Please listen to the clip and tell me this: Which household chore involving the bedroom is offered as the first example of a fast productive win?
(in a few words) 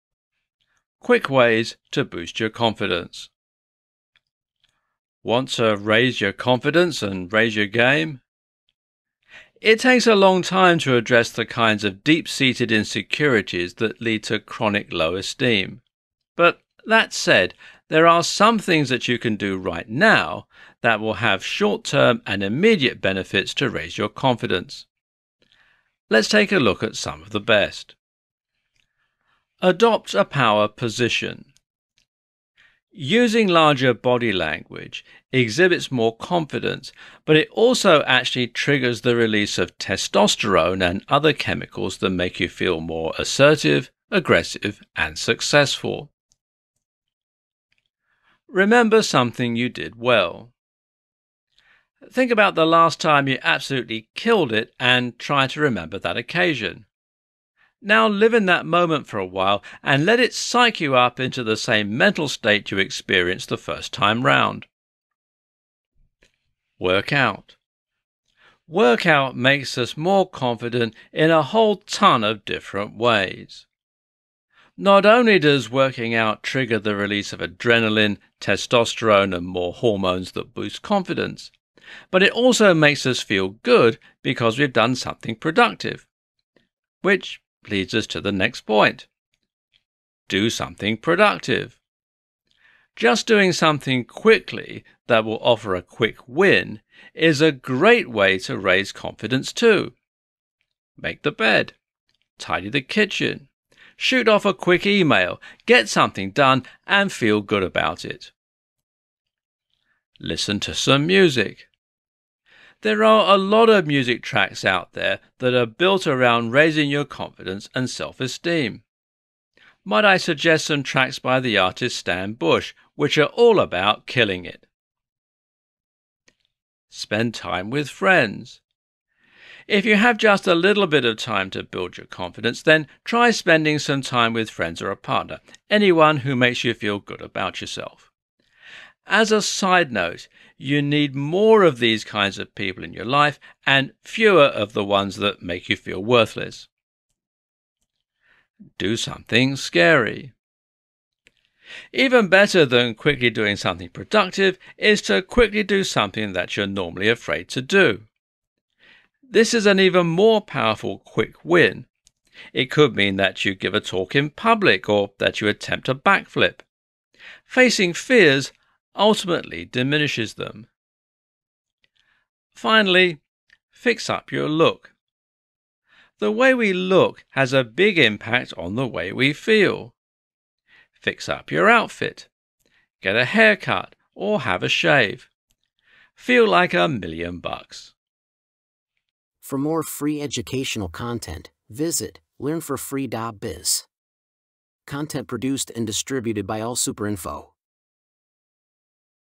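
Make the bed.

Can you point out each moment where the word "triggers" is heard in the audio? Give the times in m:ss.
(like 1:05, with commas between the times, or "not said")
0:38, 1:16.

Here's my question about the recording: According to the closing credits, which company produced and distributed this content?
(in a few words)
AllSuperInfo.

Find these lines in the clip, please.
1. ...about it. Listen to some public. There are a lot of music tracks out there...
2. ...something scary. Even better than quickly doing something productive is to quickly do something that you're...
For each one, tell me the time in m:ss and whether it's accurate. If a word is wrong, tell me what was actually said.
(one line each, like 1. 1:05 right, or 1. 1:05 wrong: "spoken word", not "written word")
1. 1:47 wrong: "music", not "public"
2. 2:28 right.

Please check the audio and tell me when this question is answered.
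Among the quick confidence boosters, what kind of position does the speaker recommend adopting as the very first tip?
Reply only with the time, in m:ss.
0:30.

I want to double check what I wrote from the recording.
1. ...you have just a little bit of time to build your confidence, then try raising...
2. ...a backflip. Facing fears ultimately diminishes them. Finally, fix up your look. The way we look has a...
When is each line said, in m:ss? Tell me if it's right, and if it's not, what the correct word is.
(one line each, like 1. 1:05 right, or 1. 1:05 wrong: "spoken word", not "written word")
1. 2:09 wrong: "spending", not "raising"
2. 2:45 right.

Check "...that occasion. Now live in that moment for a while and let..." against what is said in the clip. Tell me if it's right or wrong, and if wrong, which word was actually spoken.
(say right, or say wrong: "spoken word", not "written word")
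right.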